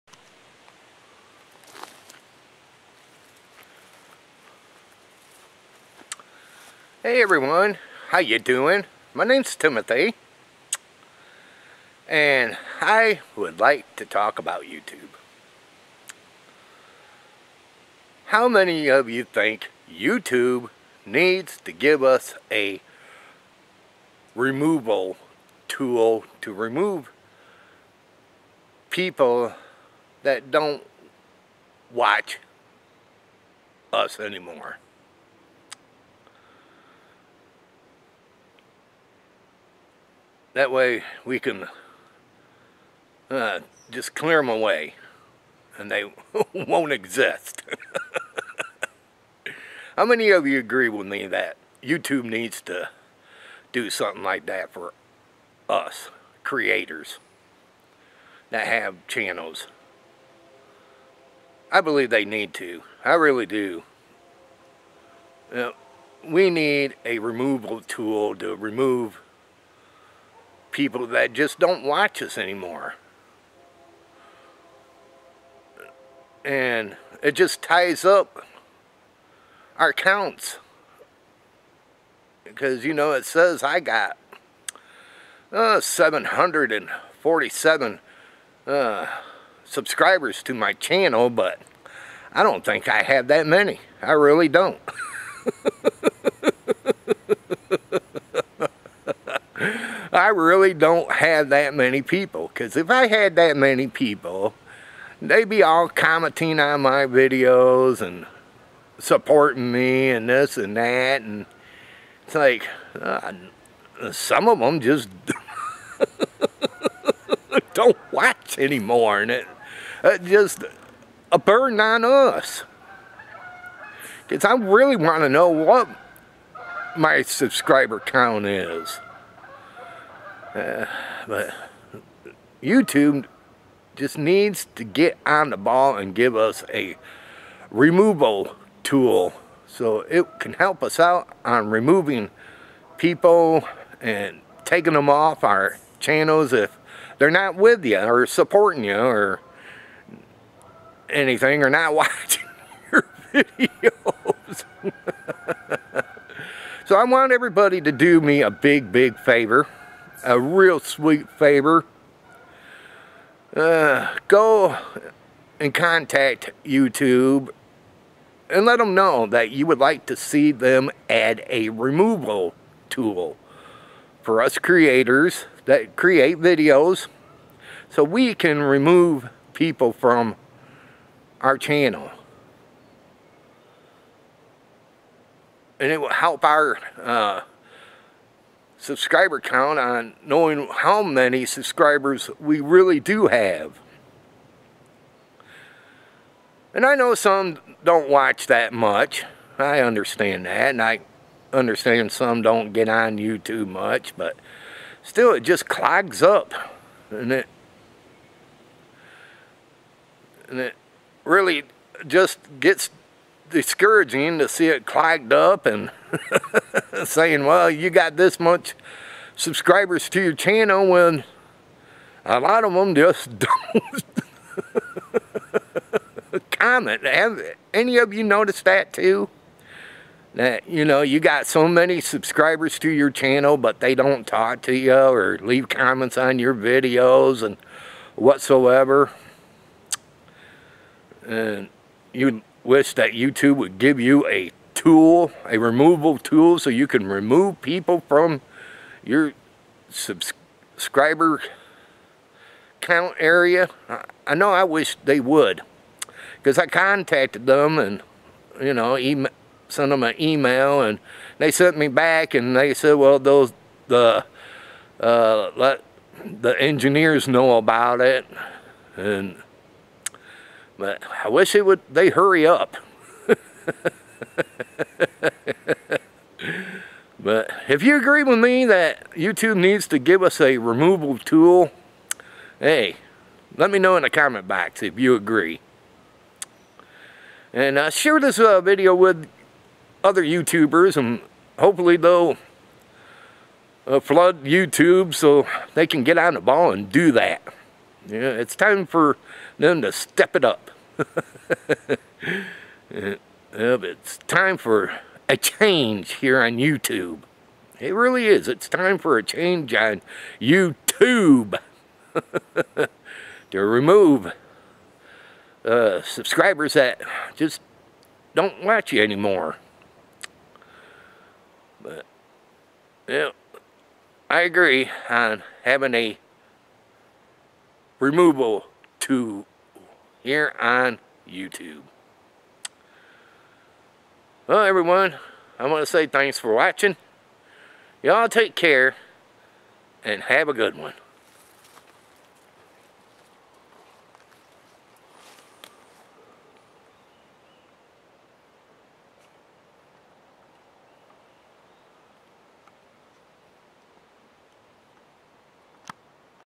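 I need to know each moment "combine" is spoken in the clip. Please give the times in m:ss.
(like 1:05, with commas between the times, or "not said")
not said.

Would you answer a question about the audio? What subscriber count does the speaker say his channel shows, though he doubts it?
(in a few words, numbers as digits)
747.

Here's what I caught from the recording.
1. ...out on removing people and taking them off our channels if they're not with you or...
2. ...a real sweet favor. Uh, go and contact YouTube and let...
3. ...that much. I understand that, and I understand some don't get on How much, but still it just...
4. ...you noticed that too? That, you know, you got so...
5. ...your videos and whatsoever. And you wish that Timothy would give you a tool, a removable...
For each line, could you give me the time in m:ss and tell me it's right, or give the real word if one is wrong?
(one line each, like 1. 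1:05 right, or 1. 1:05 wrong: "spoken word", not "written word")
1. 2:20 right
2. 2:40 right
3. 3:18 wrong: "YouTube", not "How"
4. 3:48 right
5. 3:56 wrong: "YouTube", not "Timothy".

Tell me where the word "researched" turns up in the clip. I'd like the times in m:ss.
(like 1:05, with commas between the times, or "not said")
not said.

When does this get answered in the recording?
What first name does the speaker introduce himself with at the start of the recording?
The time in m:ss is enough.
0:09.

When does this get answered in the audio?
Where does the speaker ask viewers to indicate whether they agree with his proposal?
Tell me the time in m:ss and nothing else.
4:44.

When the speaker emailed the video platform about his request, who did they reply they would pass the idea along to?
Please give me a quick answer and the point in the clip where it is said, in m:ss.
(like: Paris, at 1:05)
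the engineers, at 4:26.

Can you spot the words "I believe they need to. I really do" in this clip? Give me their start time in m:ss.
1:01.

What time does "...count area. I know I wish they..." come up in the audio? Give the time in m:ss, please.
4:12.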